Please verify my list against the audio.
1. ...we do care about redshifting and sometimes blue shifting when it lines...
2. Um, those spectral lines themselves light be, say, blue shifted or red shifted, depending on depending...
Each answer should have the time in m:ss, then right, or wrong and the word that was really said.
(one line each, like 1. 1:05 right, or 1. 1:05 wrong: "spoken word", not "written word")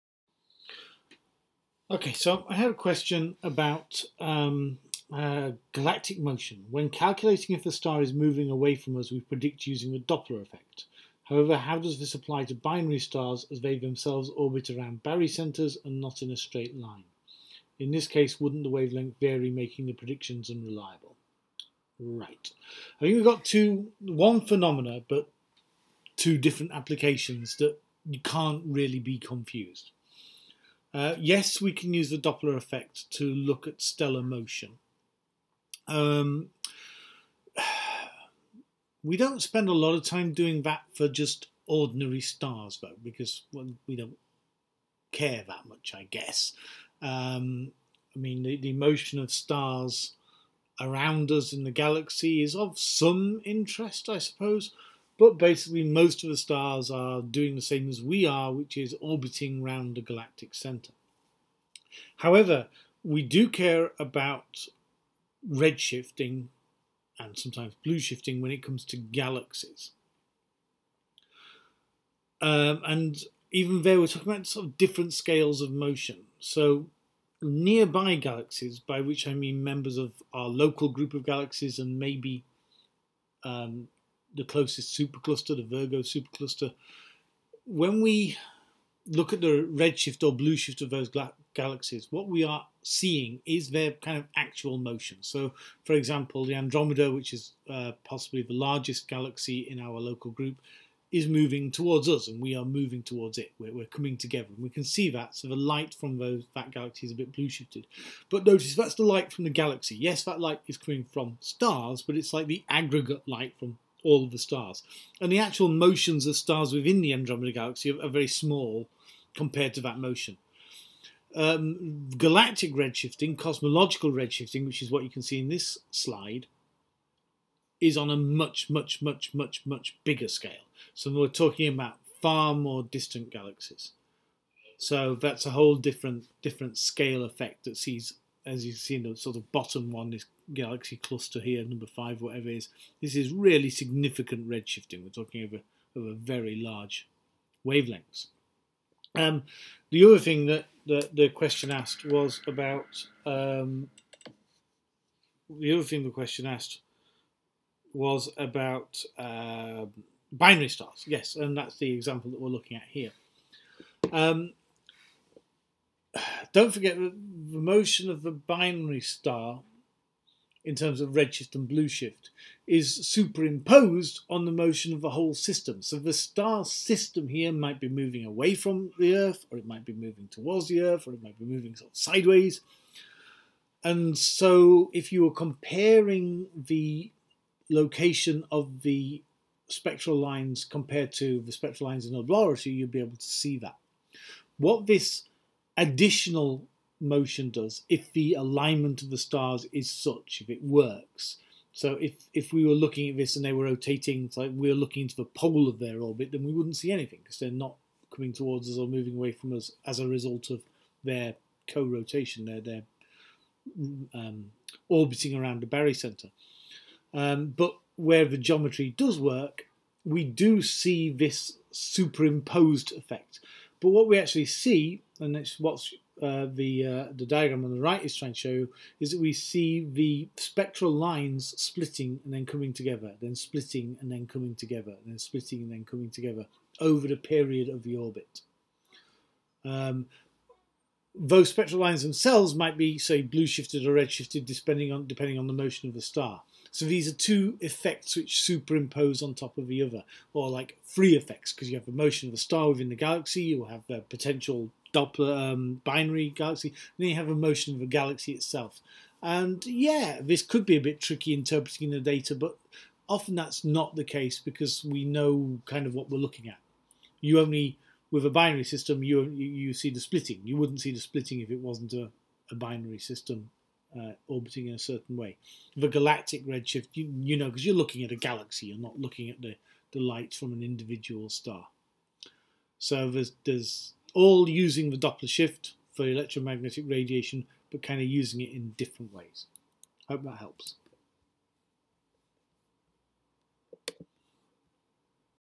1. 1:03 wrong: "comes", not "lines"
2. 3:59 wrong: "might", not "light".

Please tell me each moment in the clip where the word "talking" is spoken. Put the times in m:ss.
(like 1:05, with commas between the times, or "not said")
1:14, 2:11, 2:25.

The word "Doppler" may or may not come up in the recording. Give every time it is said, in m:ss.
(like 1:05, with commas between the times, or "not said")
0:09, 0:32, 4:14, 4:44.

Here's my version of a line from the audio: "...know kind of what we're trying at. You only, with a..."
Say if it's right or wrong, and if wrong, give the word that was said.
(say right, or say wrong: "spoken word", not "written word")
wrong: "looking", not "trying".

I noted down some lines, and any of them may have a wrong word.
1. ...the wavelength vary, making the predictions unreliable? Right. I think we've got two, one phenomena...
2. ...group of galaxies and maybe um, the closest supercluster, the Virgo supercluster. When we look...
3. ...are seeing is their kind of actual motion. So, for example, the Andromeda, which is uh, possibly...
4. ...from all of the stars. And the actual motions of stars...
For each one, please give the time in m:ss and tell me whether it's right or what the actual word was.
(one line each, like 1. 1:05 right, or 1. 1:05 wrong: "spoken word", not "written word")
1. 0:18 right
2. 1:20 right
3. 1:32 right
4. 1:53 right.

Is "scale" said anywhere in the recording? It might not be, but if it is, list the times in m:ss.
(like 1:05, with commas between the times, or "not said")
1:15, 2:10, 2:16.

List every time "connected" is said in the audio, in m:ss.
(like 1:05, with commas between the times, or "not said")
not said.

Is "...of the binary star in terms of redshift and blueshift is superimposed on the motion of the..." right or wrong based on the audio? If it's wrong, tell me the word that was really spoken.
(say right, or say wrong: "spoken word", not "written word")
right.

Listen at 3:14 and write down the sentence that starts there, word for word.
What this additional motion does if the alignment of the stars is such, if it works.